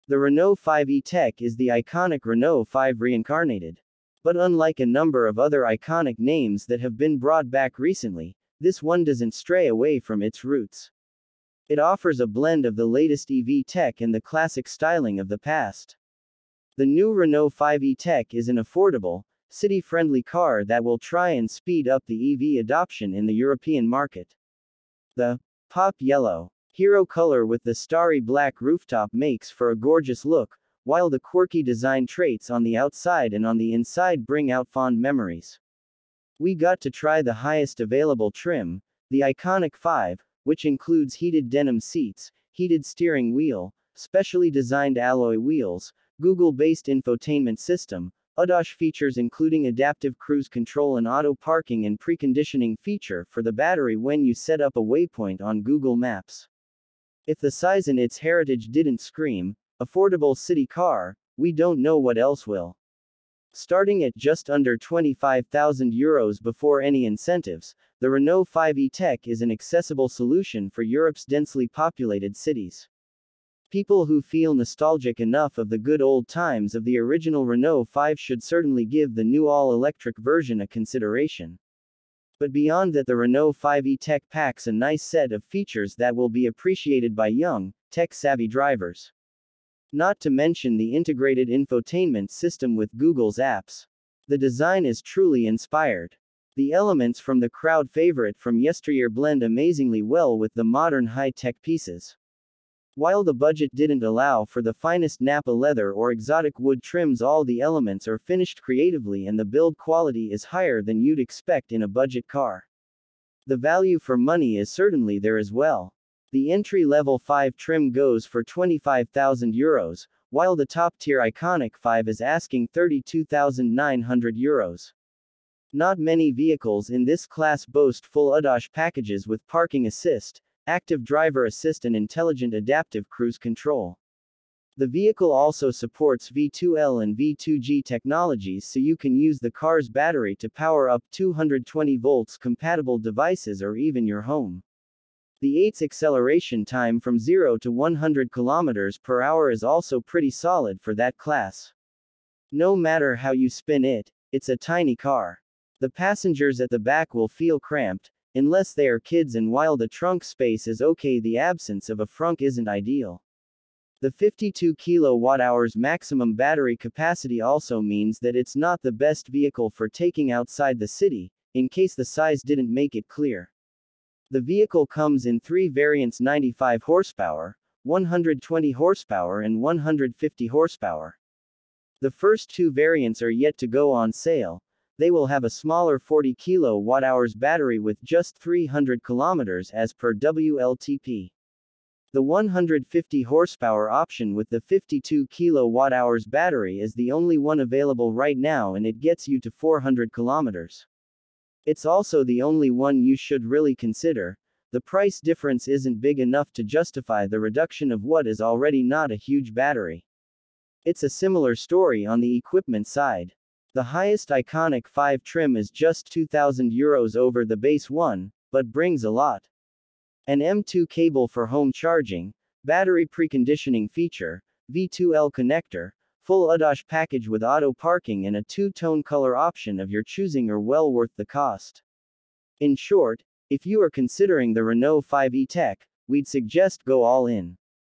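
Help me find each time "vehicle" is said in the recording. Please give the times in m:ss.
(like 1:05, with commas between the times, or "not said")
2:06, 2:14, 2:49, 2:54.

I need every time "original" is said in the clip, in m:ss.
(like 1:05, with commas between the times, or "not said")
1:16.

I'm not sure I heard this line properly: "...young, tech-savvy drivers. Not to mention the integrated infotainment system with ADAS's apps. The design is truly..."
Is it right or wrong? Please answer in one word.
wrong.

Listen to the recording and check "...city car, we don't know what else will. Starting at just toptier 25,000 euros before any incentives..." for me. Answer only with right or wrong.
wrong.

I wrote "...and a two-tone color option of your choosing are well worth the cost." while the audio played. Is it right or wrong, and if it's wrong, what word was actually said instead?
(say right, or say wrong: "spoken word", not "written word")
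right.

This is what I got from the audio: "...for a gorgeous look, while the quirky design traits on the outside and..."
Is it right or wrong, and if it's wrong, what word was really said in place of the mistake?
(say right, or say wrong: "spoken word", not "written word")
right.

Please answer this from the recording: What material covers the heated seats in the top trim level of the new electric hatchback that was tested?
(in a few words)
Denim.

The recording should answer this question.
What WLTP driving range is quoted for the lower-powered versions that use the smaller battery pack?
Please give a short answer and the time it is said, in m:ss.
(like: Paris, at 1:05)
300 km, at 3:08.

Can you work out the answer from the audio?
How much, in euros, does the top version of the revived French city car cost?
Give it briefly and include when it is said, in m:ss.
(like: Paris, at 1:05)
32,900 euros, at 2:02.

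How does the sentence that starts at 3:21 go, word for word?
It's also the only one you should really consider.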